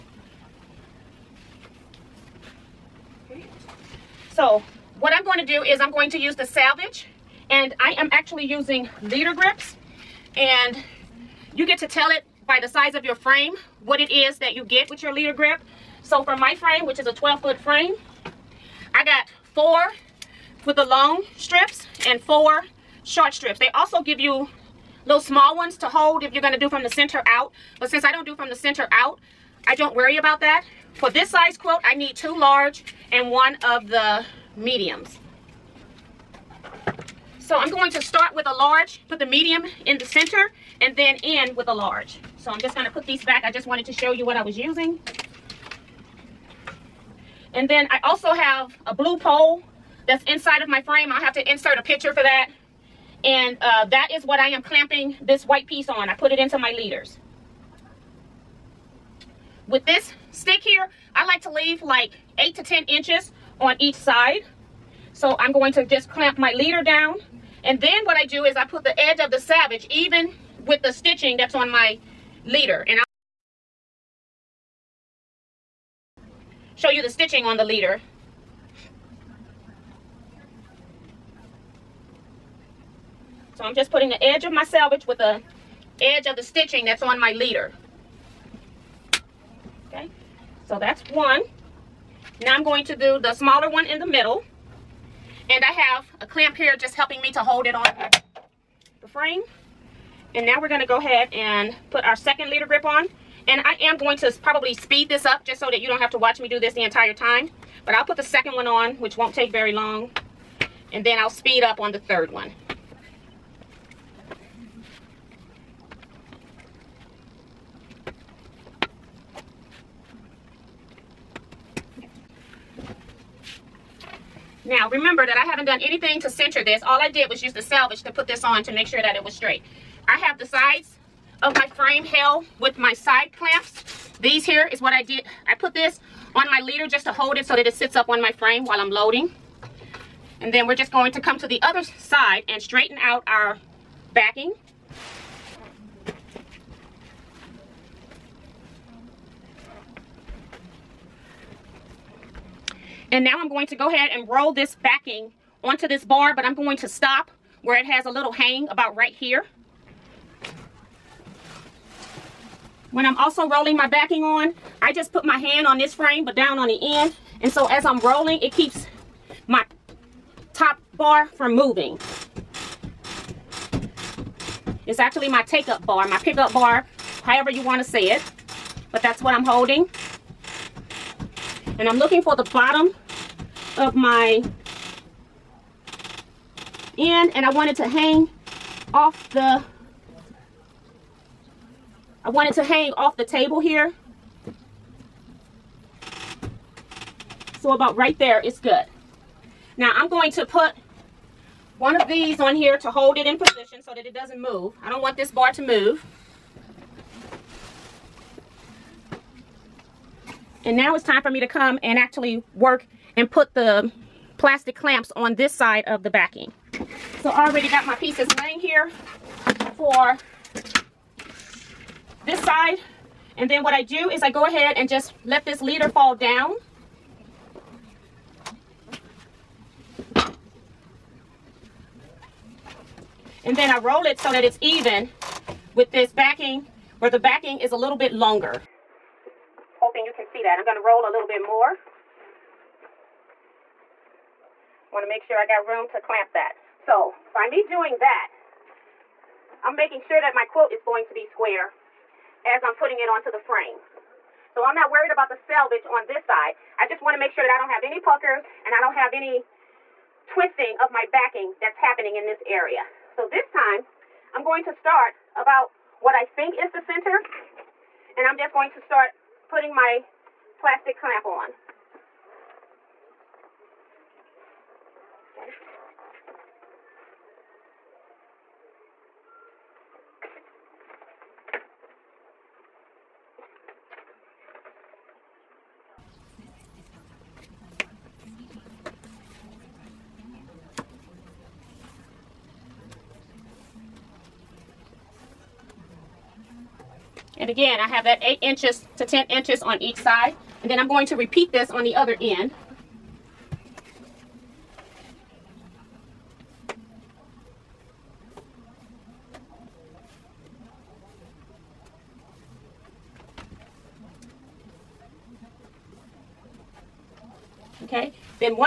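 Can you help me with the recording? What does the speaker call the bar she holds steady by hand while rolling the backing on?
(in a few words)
take-up bar.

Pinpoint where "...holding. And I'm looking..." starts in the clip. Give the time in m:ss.
2:59.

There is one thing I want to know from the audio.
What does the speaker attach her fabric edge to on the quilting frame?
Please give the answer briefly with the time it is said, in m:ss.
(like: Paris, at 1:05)
leader grips, at 0:09.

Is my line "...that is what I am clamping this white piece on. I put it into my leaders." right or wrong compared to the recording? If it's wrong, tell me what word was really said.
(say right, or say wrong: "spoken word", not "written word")
right.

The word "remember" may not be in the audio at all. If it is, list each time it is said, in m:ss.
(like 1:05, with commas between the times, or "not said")
2:04.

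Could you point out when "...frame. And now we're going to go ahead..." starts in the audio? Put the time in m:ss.
1:39.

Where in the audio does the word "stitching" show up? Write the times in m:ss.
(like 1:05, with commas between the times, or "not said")
1:10, 1:17, 1:26.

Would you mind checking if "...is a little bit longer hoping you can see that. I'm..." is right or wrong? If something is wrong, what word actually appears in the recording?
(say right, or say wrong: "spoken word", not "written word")
right.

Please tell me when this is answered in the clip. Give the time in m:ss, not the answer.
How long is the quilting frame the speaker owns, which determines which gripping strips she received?
0:17.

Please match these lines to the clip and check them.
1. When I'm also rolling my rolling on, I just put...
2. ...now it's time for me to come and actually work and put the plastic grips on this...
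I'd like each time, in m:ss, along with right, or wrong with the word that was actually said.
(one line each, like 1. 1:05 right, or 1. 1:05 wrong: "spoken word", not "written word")
1. 2:42 wrong: "backing", not "rolling"
2. 3:30 wrong: "clamps", not "grips".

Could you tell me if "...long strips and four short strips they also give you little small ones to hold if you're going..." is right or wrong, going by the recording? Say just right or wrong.
right.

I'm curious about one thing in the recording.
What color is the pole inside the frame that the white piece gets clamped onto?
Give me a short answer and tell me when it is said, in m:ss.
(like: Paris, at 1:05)
blue, at 0:48.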